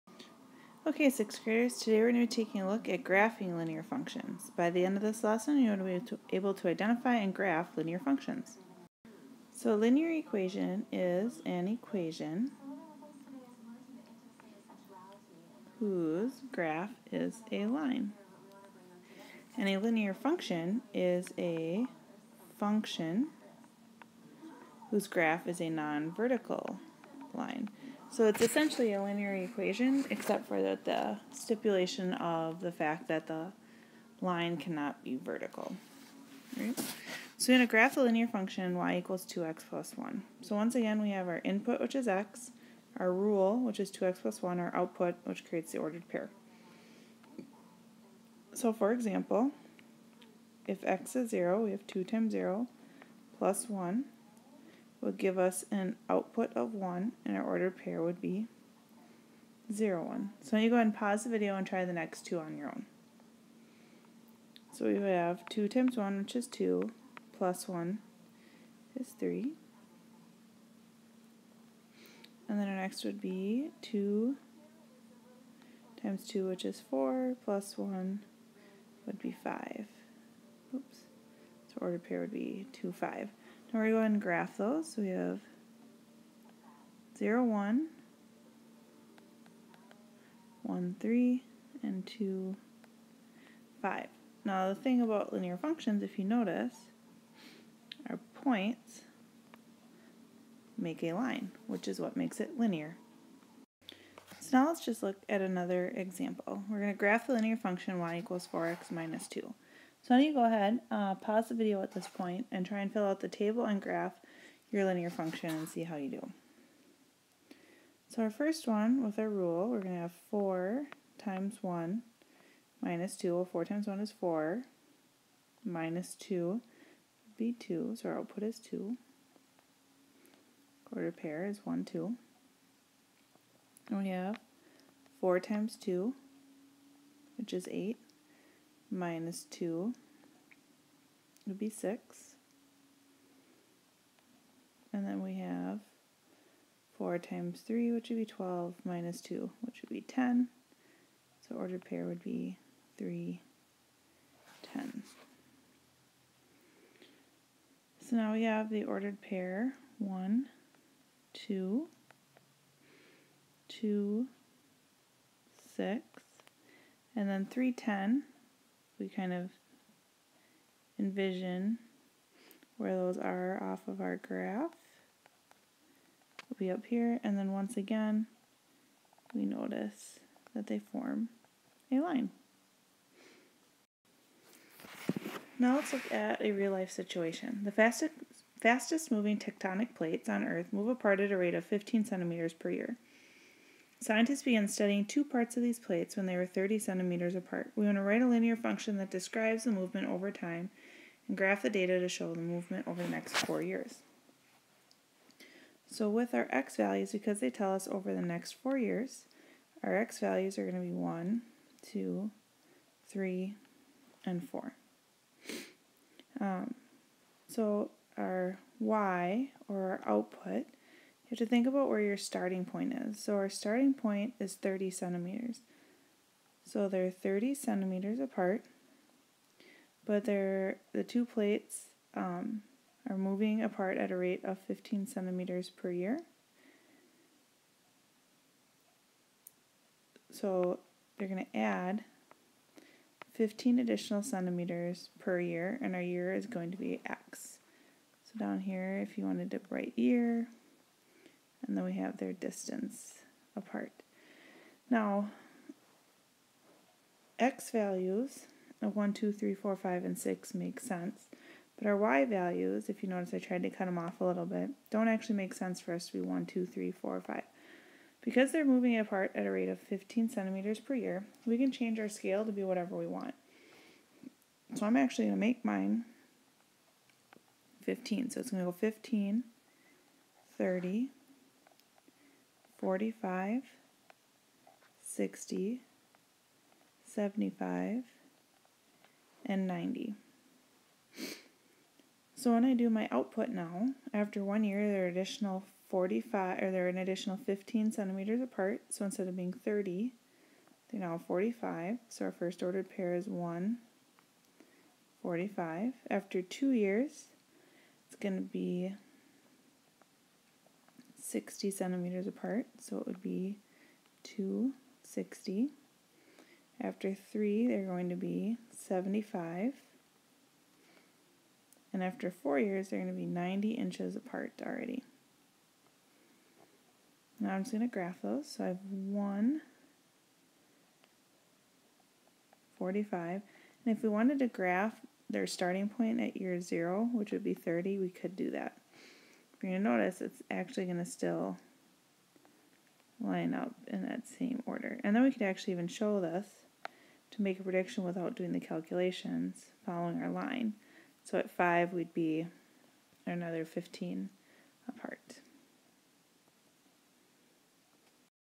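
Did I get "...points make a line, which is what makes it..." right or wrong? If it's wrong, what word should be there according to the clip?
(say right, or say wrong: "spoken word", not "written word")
right.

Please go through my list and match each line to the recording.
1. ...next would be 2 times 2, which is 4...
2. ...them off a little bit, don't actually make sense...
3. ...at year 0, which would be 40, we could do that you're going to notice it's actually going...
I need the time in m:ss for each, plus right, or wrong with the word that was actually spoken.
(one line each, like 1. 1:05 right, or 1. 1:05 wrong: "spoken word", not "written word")
1. 1:12 right
2. 4:23 right
3. 5:36 wrong: "30", not "40".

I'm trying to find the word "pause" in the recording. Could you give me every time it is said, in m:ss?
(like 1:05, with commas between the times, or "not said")
1:00, 1:51.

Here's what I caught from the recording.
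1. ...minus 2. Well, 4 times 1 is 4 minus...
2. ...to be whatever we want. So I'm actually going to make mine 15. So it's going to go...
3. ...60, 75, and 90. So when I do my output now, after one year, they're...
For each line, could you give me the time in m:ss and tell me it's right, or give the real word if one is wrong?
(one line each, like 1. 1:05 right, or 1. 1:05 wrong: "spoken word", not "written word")
1. 2:02 right
2. 4:32 right
3. 4:45 right.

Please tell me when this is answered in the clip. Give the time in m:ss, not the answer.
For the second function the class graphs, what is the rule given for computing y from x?
1:48.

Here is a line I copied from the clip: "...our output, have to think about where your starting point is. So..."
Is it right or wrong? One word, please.
right.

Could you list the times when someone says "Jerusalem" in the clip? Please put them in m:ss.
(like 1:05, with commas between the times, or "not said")
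not said.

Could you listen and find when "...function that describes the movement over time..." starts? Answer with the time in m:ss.
3:18.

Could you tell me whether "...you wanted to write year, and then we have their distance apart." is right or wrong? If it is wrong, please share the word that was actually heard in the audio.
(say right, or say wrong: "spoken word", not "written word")
right.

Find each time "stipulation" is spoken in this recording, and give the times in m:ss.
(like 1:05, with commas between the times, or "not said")
0:31.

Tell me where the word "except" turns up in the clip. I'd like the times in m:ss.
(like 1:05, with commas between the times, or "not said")
0:30.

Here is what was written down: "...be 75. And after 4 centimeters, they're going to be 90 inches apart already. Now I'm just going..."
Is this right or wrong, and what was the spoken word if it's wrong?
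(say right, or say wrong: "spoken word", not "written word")
wrong: "years", not "centimeters".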